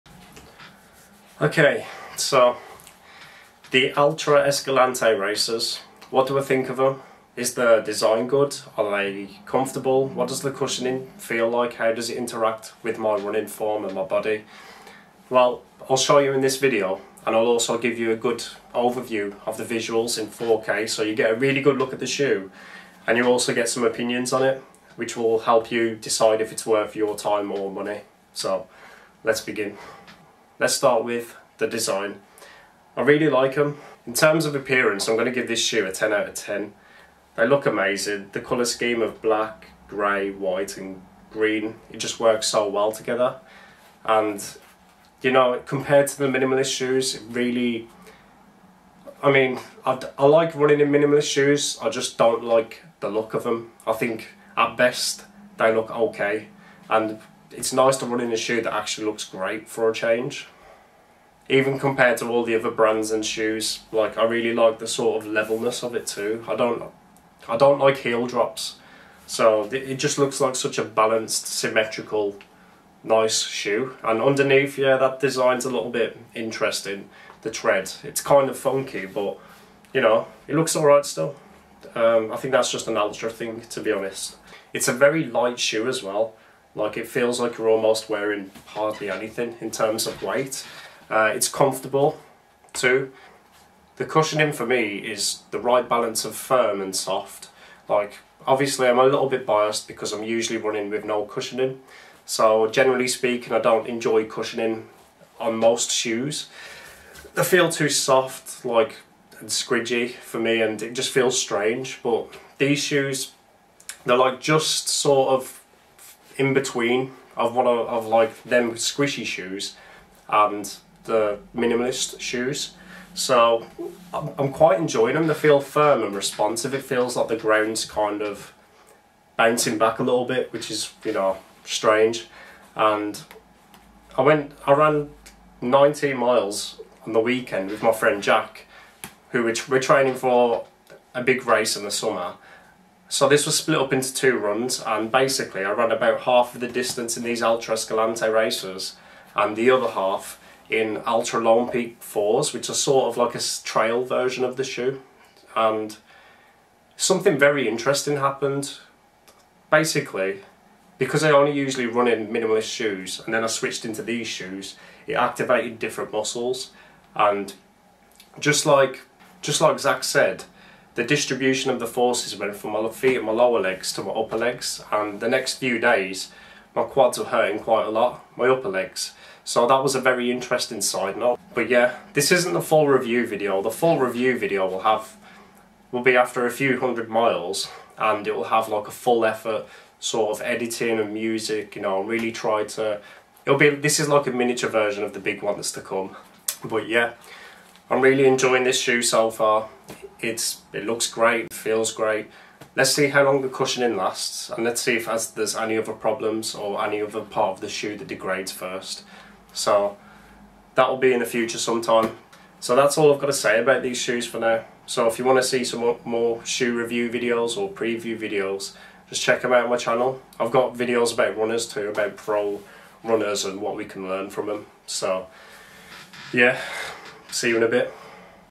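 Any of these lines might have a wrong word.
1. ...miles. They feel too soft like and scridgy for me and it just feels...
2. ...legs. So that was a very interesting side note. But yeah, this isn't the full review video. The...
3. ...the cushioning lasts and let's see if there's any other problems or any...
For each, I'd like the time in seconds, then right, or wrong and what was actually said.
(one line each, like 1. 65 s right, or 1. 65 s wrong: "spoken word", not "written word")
1. 105 s wrong: "shoes", not "miles"
2. 178 s right
3. 203 s right.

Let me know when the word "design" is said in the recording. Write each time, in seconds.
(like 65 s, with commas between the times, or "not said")
7 s, 31 s, 75 s.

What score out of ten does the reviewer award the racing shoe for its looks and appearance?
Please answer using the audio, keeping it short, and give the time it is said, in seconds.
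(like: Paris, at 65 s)
10, at 35 s.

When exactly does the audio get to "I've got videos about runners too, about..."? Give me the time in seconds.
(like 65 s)
220 s.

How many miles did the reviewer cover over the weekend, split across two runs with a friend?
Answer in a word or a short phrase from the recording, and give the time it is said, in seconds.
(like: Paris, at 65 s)
19, at 135 s.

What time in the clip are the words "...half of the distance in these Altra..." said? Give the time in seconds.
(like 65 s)
146 s.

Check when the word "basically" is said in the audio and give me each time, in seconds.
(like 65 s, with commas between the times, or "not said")
145 s, 159 s.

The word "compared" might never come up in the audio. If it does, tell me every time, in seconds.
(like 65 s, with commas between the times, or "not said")
45 s, 61 s.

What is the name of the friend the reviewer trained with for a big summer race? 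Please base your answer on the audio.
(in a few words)
Jack.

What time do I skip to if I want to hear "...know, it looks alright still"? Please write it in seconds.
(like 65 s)
79 s.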